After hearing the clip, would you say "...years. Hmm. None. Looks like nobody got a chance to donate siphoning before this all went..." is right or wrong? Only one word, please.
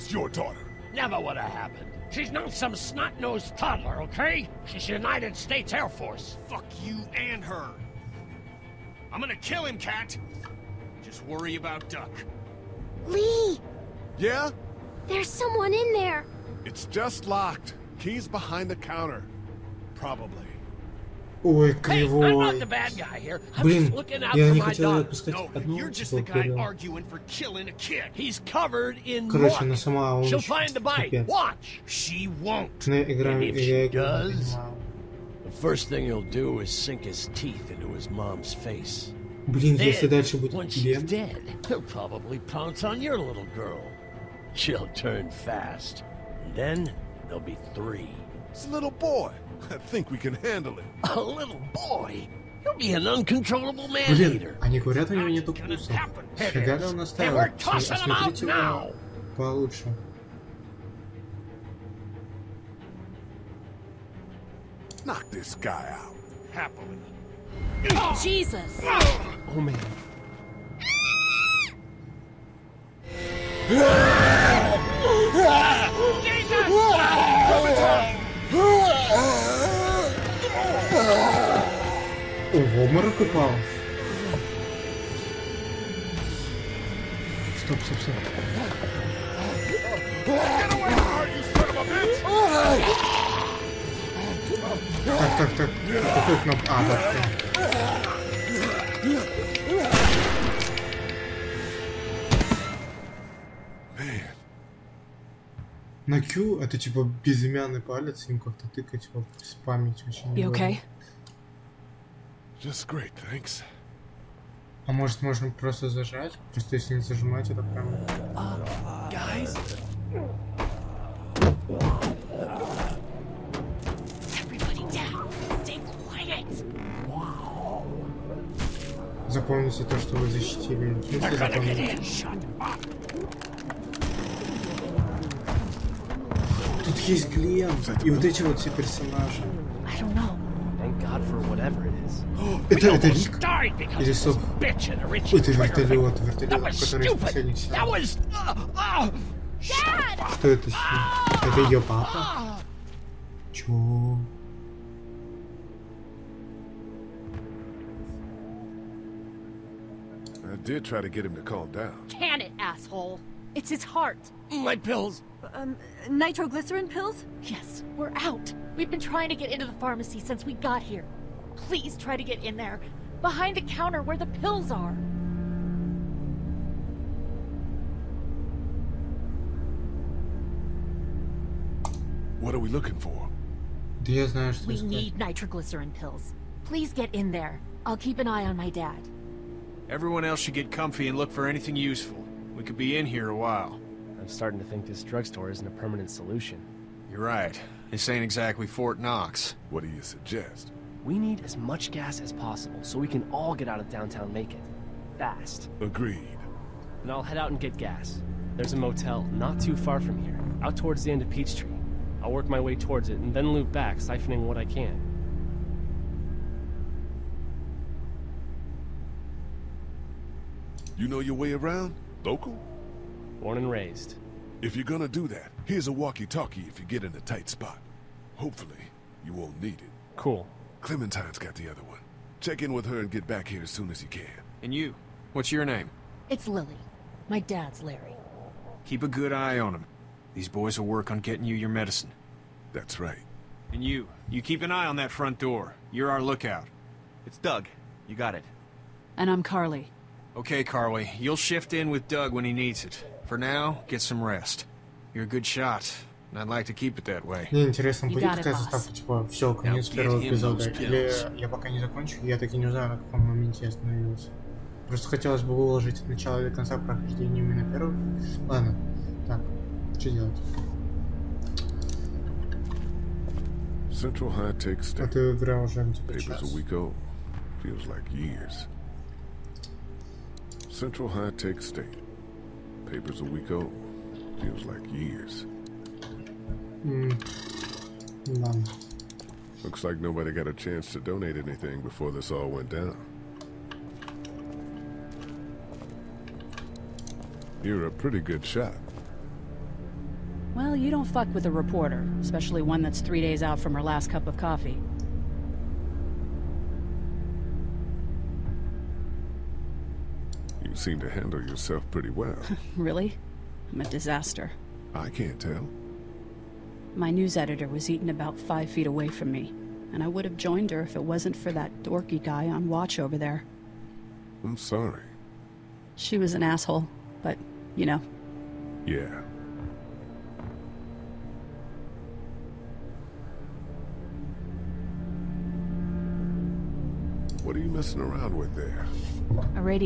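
wrong.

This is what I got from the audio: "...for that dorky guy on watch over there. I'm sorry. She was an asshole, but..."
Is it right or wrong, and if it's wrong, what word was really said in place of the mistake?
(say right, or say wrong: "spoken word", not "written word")
right.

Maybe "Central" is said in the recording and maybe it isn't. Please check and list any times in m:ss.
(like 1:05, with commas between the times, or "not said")
4:33, 4:40.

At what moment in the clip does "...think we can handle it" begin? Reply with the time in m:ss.
0:49.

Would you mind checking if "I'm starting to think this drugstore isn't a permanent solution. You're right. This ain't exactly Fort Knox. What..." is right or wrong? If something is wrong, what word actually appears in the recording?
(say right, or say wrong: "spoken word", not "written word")
right.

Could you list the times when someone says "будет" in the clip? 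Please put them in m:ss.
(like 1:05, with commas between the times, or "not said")
0:40, 4:18.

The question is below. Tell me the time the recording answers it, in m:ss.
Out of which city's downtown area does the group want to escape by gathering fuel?
3:24.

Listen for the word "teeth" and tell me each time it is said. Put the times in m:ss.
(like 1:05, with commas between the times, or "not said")
0:37.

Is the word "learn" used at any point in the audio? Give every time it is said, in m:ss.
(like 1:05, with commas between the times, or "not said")
not said.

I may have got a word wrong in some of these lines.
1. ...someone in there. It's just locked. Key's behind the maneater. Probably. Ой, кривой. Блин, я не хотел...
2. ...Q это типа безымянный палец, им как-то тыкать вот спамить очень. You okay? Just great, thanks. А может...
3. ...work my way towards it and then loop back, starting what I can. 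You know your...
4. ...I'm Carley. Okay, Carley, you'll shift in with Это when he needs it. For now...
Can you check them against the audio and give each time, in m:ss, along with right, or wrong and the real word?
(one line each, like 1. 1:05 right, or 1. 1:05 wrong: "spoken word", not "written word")
1. 0:15 wrong: "counter", not "maneater"
2. 1:46 right
3. 3:32 wrong: "siphoning", not "starting"
4. 4:09 wrong: "Doug", not "Это".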